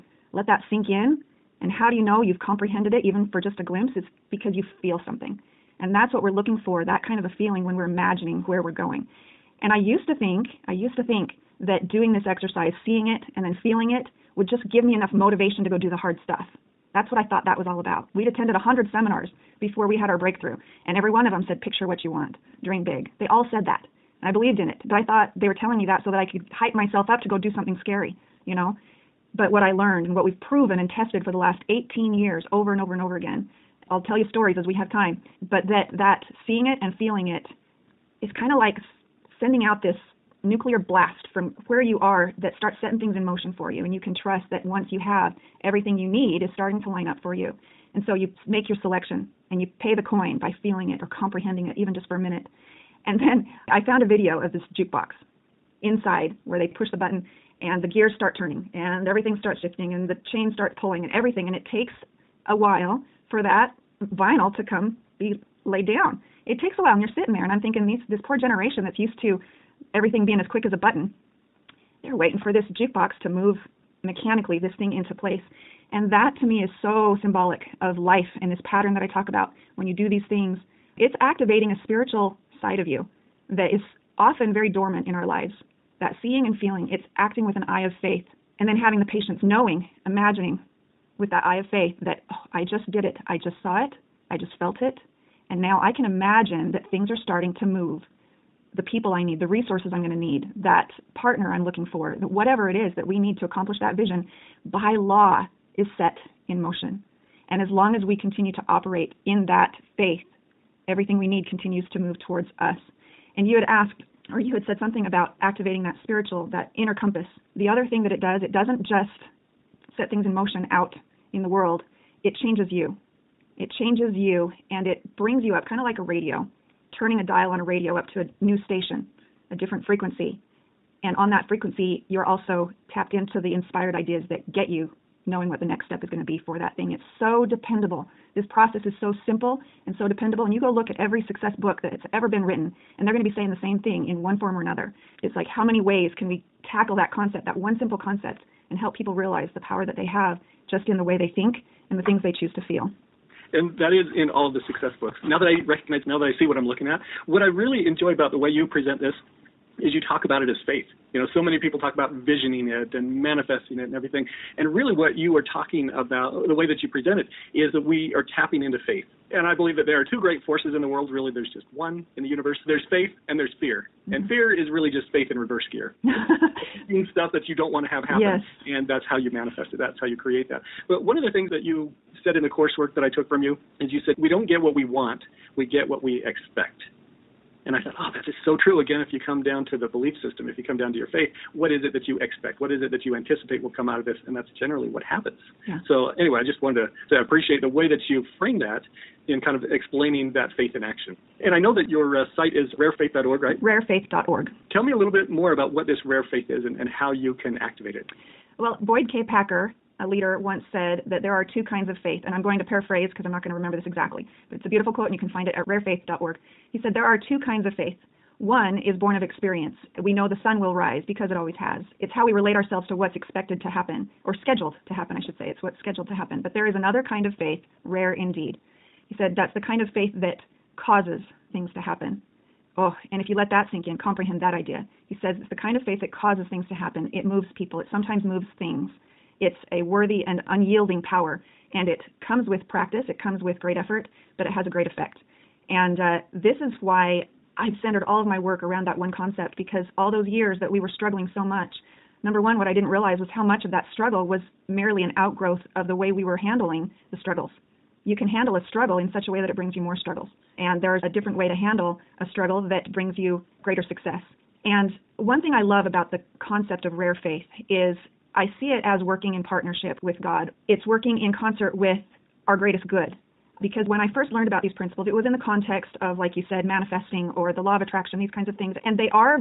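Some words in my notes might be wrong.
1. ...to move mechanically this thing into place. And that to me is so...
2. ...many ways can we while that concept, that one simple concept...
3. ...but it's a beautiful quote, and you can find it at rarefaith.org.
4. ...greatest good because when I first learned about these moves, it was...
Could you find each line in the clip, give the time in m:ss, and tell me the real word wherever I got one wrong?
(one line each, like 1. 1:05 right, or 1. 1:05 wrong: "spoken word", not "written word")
1. 1:13 right
2. 2:25 wrong: "tackle", not "while"
3. 3:34 right
4. 4:32 wrong: "principles", not "moves".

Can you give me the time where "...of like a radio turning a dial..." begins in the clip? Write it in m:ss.
2:05.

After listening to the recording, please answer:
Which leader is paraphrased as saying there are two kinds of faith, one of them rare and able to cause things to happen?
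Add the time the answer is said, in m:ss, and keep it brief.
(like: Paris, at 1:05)
Boyd K. Packer, at 3:28.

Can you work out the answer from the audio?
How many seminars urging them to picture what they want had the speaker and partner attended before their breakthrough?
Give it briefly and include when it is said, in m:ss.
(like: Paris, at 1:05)
100, at 0:18.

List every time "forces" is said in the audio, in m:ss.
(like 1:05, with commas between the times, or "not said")
2:50.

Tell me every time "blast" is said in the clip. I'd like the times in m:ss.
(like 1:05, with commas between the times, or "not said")
0:40.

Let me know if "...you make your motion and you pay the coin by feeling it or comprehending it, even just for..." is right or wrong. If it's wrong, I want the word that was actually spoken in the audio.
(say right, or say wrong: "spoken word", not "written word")
wrong: "selection", not "motion".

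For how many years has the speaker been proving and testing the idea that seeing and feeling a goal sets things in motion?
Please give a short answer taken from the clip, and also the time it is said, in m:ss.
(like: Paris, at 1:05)
18, at 0:31.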